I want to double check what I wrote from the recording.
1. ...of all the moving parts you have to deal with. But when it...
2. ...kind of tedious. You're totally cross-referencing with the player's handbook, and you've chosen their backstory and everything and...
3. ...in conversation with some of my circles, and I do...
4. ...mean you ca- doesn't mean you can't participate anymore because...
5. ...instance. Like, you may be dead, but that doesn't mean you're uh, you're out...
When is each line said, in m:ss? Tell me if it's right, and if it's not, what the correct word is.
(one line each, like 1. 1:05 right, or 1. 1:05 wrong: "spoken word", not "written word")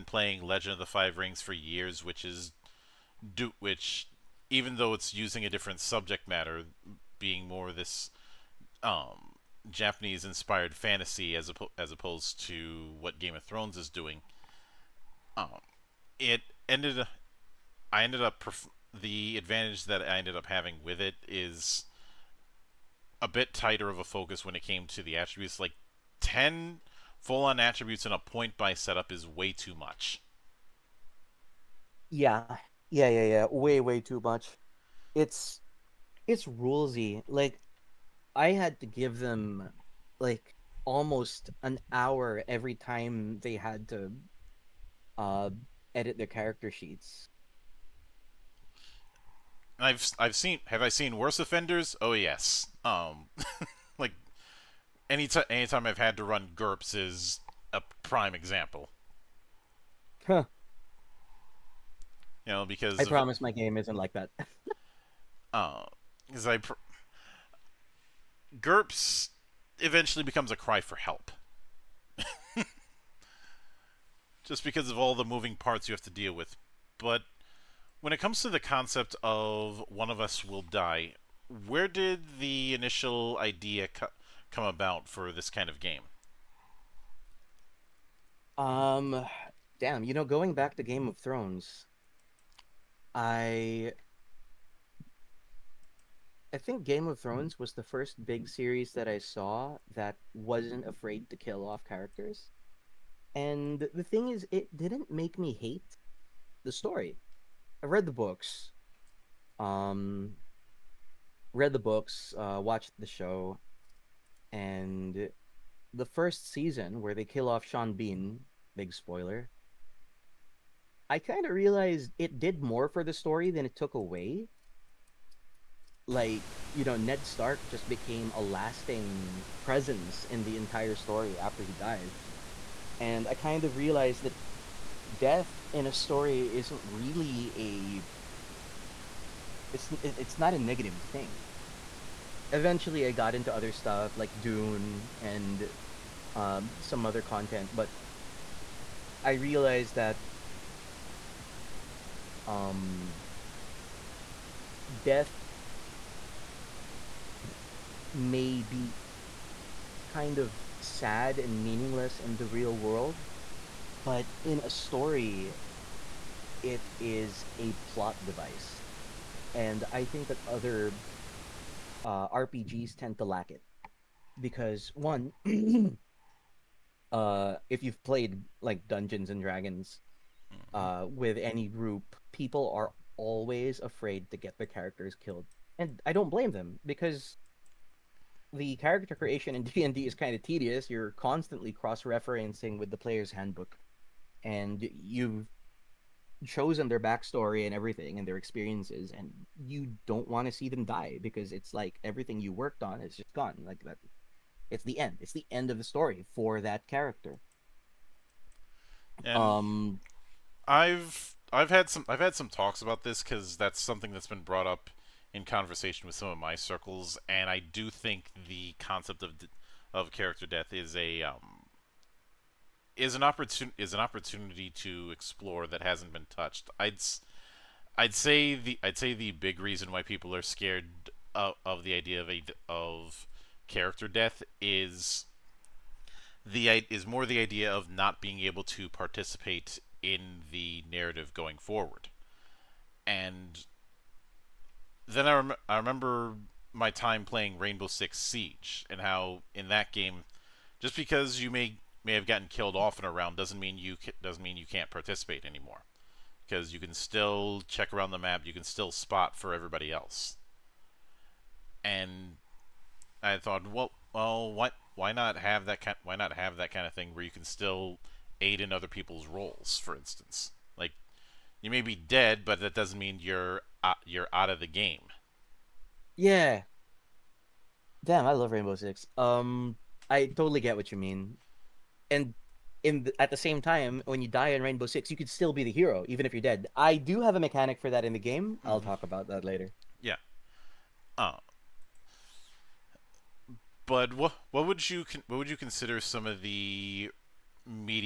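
1. 1:14 right
2. 3:10 wrong: "constantly", not "totally"
3. 3:35 right
4. 4:13 right
5. 4:29 right.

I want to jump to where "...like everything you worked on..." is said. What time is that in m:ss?
3:21.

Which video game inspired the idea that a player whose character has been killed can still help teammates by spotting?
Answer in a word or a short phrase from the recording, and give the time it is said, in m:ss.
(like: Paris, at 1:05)
Rainbow Six Siege, at 4:07.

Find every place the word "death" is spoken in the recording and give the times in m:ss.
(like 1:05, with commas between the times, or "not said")
2:15, 2:35, 3:40, 3:54.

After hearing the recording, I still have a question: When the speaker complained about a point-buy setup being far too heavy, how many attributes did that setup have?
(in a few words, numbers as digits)
10.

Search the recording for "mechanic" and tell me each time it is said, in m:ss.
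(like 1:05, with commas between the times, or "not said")
4:47.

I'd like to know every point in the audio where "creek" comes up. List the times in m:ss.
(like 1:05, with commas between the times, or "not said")
not said.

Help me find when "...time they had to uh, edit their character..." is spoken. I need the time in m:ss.
0:42.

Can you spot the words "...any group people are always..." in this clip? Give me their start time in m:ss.
3:01.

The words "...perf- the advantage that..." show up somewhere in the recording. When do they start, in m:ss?
0:18.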